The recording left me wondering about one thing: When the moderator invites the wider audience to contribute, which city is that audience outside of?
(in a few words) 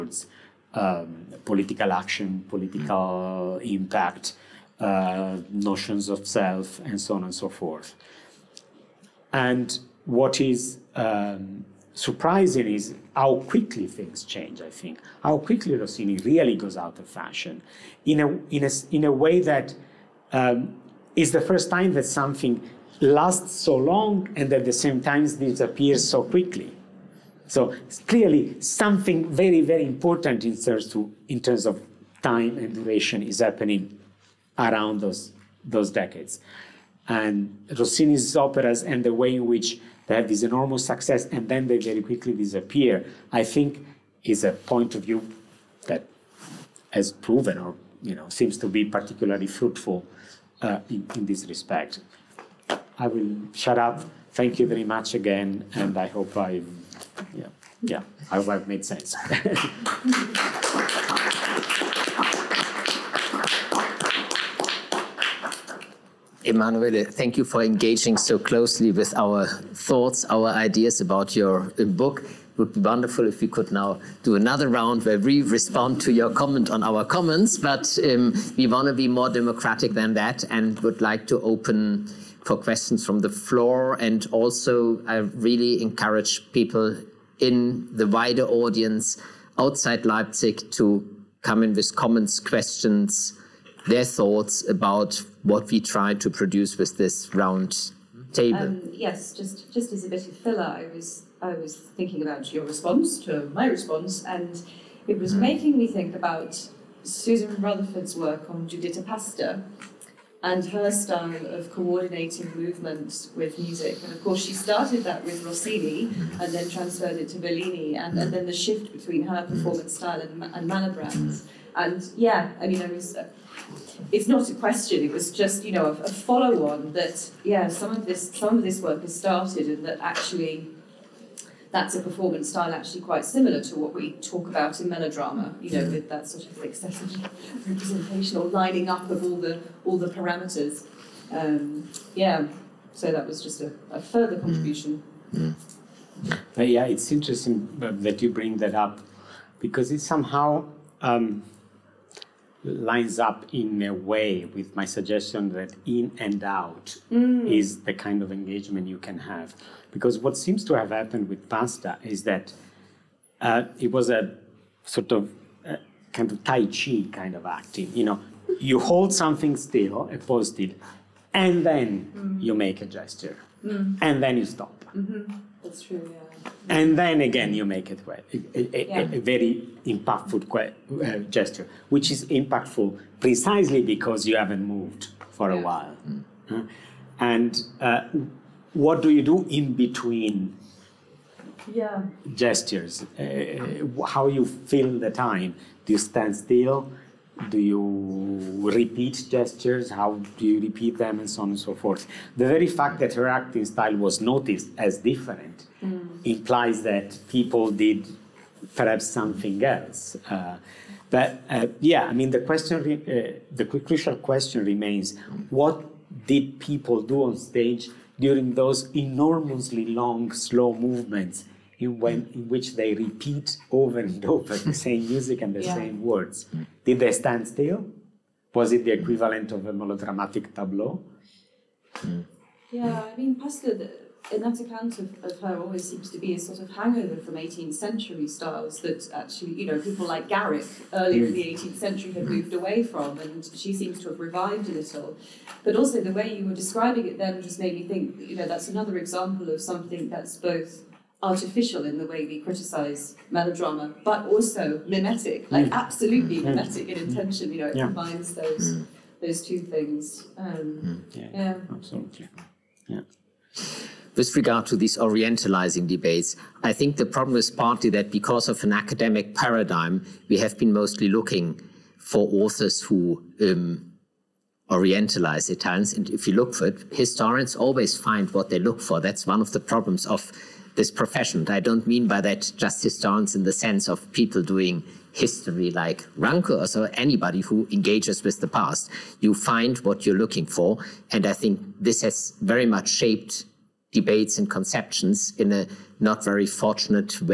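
Leipzig.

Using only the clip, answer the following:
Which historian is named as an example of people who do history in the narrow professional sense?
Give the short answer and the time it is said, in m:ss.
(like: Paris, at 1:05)
Ranke, at 4:46.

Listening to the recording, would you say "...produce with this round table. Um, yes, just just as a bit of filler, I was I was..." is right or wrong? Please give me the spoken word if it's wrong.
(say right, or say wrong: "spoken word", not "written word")
right.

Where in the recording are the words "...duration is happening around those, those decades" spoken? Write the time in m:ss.
0:32.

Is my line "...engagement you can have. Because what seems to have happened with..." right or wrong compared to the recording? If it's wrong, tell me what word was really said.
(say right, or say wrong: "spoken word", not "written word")
right.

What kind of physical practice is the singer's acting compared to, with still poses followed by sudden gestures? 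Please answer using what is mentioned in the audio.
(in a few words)
Tai Chi.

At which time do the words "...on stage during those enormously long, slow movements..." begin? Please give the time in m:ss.
3:37.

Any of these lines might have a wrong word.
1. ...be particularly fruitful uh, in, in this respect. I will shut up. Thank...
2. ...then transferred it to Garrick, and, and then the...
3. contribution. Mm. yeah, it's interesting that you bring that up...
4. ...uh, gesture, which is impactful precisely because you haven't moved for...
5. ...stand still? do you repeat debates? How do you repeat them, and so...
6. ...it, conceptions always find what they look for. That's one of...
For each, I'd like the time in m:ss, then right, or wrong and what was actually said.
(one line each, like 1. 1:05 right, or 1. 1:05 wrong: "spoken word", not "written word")
1. 0:48 right
2. 1:56 wrong: "Bellini", not "Garrick"
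3. 2:24 right
4. 3:00 right
5. 3:15 wrong: "gestures", not "debates"
6. 4:36 wrong: "historians", not "conceptions".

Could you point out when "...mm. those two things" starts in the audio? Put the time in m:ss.
4:18.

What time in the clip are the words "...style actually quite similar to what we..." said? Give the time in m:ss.
2:12.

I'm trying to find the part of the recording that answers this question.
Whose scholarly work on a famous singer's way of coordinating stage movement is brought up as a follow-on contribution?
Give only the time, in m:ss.
1:47.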